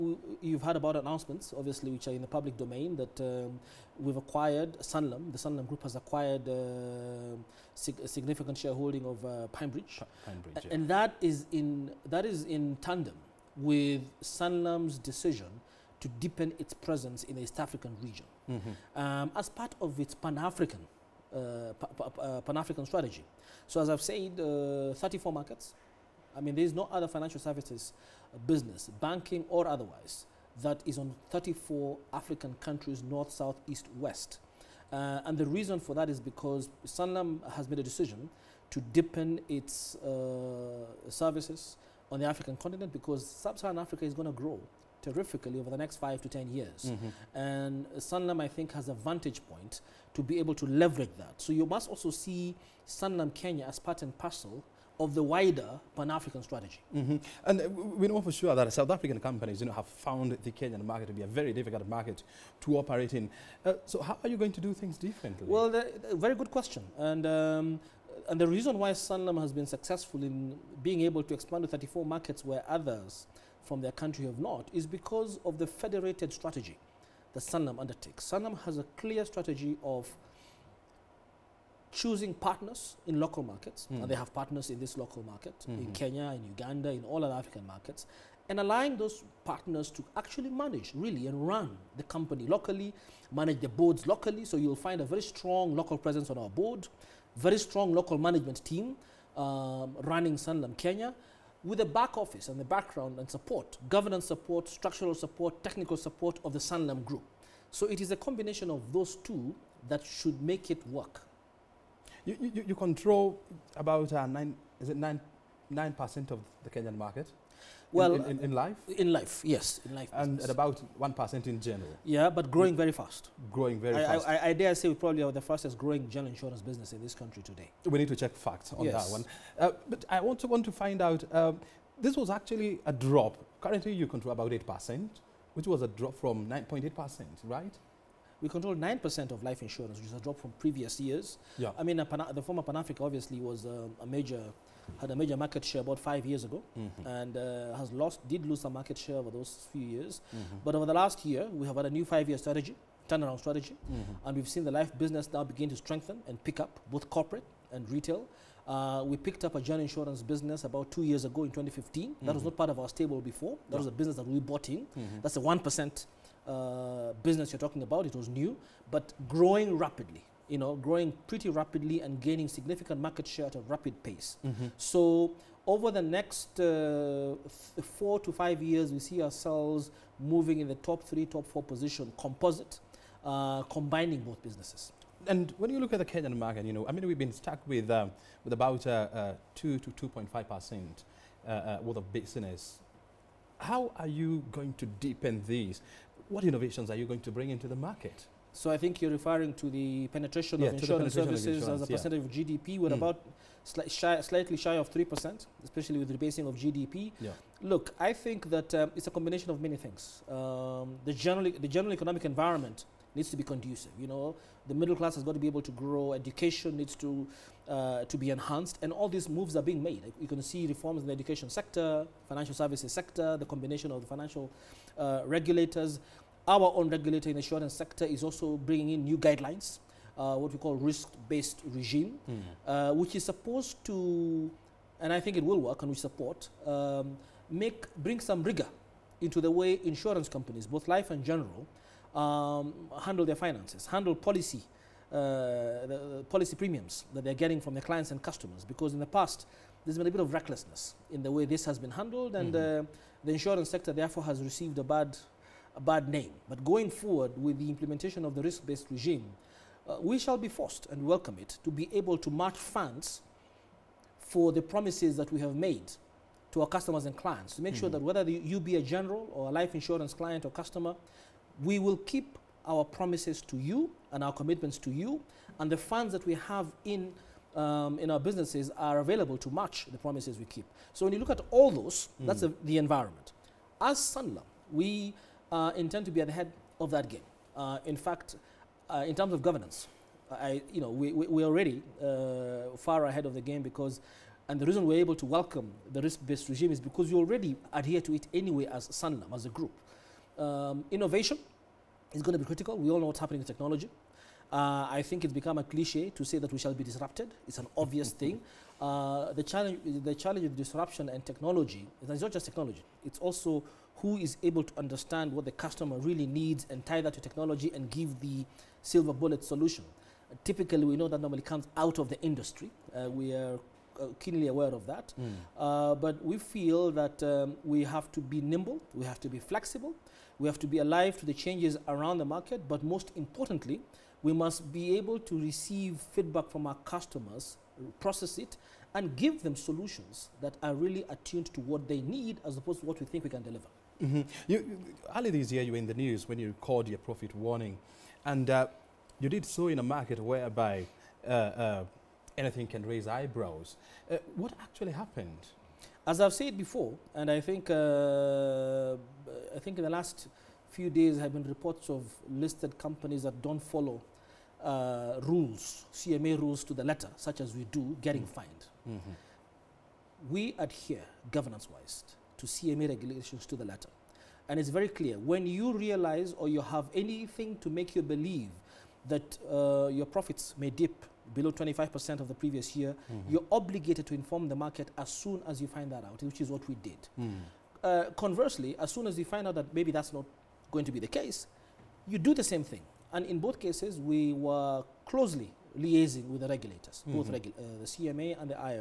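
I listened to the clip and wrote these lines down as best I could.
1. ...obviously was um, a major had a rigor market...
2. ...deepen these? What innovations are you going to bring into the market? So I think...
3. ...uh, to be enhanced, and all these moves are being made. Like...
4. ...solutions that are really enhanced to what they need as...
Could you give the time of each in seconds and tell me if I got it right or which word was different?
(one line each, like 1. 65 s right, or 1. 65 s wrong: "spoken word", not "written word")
1. 143 s wrong: "major", not "rigor"
2. 194 s right
3. 217 s right
4. 339 s wrong: "attuned", not "enhanced".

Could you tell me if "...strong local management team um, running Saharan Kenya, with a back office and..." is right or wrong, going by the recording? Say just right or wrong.
wrong.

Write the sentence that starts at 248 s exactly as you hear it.
Because in the past, there's been a bit of recklessness in the way this has been handled, and mm -hmm.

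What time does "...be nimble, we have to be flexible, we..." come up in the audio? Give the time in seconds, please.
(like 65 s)
328 s.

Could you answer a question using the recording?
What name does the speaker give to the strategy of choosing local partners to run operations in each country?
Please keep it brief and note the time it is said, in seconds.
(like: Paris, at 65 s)
federated strategy, at 75 s.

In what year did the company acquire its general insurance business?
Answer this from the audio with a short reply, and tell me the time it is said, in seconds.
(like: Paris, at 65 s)
2015, at 161 s.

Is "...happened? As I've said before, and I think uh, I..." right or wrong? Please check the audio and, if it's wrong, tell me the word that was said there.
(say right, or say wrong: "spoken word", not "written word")
right.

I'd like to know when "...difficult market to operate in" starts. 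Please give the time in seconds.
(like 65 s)
61 s.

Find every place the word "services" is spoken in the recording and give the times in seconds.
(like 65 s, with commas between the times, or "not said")
27 s, 41 s, 201 s, 222 s.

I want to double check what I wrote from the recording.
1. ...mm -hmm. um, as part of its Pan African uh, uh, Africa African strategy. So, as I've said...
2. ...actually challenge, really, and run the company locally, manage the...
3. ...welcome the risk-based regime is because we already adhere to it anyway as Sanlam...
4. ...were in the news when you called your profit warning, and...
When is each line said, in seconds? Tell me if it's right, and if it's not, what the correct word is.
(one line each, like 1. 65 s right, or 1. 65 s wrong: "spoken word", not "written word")
1. 18 s wrong: "Pan", not "Africa"
2. 90 s wrong: "manage", not "challenge"
3. 295 s right
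4. 345 s right.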